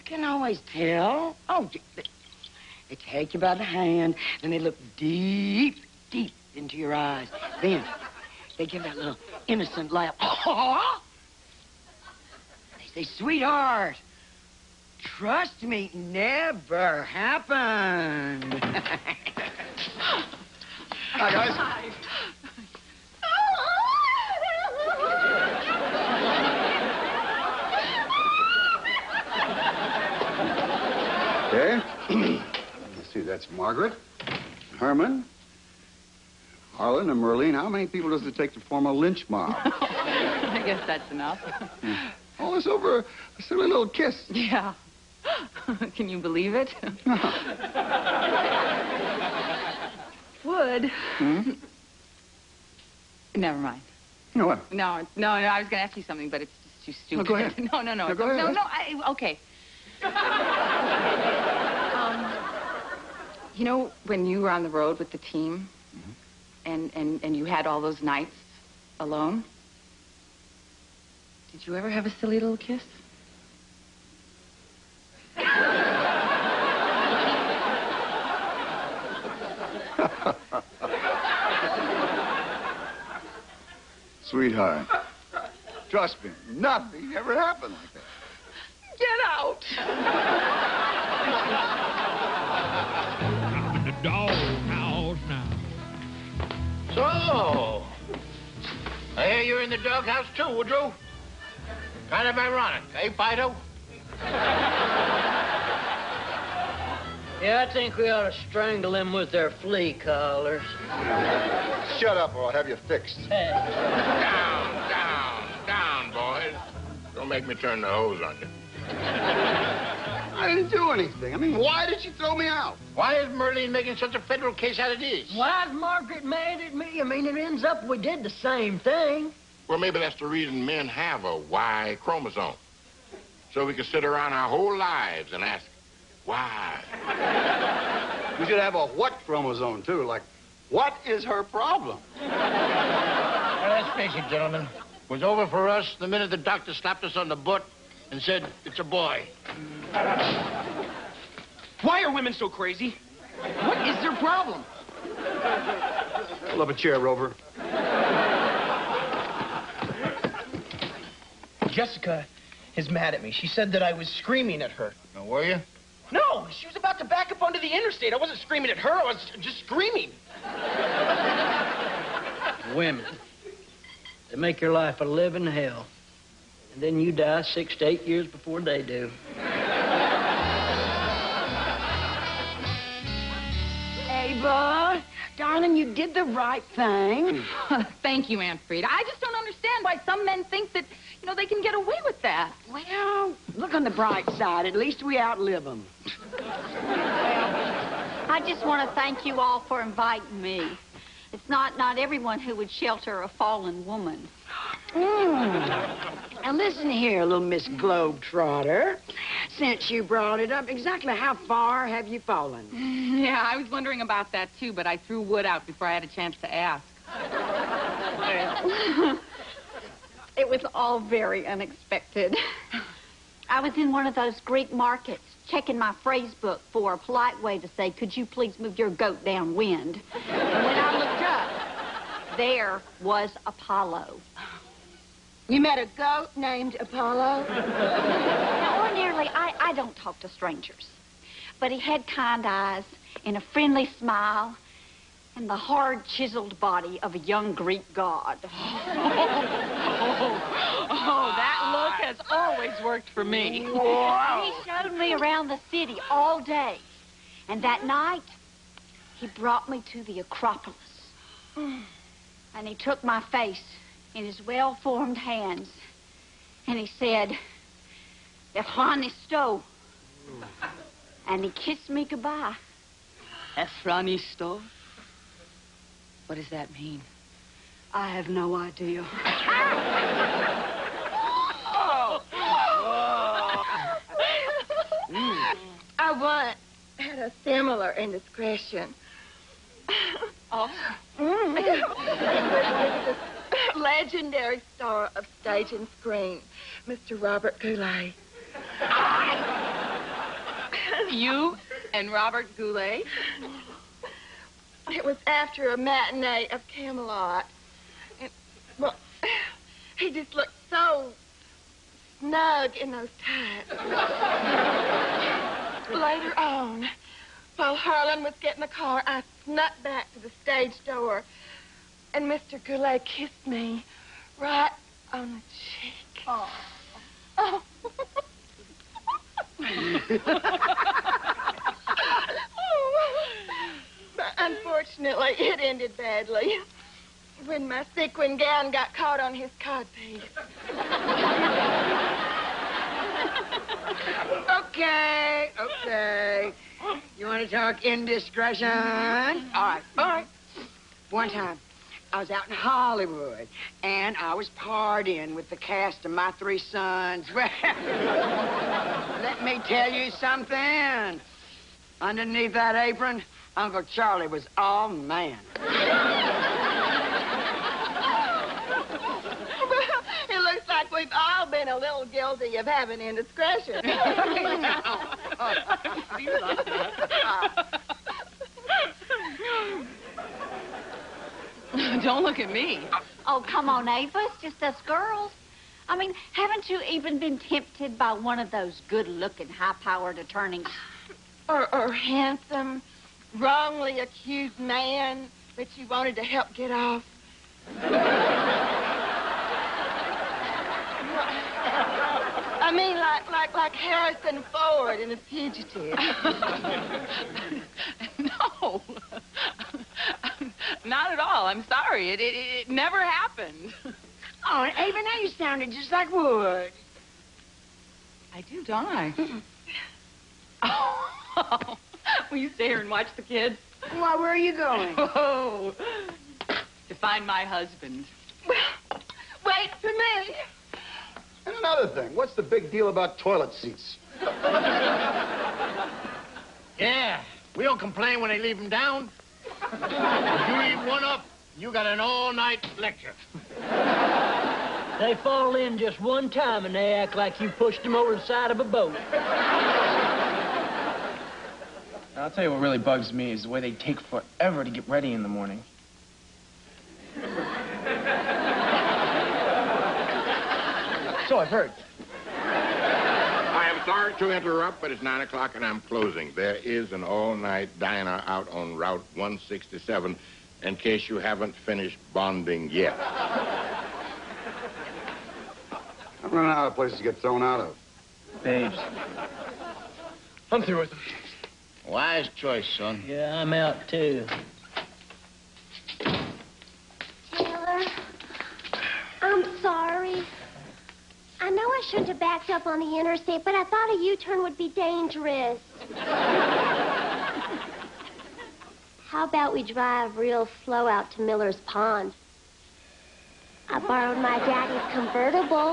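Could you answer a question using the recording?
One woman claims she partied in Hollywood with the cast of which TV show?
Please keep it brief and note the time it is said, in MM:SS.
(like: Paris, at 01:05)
My Three Sons, at 05:56.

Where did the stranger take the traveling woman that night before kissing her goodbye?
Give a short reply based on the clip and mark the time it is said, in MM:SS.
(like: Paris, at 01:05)
The Acropolis, at 04:20.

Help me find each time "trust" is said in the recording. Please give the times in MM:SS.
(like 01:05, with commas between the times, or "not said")
00:15, 01:25.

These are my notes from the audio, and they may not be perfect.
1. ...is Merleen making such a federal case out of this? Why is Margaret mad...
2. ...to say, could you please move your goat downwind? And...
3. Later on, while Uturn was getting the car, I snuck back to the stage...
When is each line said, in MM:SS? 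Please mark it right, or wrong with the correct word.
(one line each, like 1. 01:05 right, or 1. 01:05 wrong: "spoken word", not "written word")
1. 02:03 right
2. 03:47 right
3. 05:15 wrong: "Harlan", not "Uturn".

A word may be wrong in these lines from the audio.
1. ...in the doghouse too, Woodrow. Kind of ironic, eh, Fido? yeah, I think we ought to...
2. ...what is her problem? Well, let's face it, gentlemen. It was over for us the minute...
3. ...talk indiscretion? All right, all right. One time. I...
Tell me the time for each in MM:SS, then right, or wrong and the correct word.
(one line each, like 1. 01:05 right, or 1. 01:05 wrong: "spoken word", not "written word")
1. 01:39 right
2. 02:20 right
3. 05:47 right.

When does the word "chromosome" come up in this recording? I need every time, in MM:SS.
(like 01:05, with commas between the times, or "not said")
02:11, 02:19.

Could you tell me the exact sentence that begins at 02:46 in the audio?
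No, she was about to back up onto the interstate.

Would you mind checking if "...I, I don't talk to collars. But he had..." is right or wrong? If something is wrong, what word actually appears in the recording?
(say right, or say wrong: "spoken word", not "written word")
wrong: "strangers", not "collars".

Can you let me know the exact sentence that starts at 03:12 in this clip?
Well, look on the bright side.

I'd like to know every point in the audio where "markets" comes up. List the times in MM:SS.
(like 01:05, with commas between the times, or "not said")
03:44.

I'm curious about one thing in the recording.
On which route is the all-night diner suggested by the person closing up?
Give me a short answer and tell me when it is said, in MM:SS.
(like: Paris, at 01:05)
Route 167, at 07:48.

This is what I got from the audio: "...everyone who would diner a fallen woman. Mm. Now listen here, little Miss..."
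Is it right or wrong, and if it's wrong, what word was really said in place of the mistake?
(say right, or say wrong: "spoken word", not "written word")
wrong: "shelter", not "diner".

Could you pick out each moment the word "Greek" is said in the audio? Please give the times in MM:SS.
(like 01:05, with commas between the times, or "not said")
03:44, 04:07.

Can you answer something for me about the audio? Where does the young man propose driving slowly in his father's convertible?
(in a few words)
Miller's Pond.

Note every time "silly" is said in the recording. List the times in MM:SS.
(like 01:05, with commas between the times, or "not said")
00:43, 01:12.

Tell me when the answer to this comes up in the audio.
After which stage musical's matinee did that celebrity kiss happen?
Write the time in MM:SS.
05:06.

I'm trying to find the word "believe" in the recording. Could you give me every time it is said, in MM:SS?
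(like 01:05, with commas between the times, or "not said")
00:46.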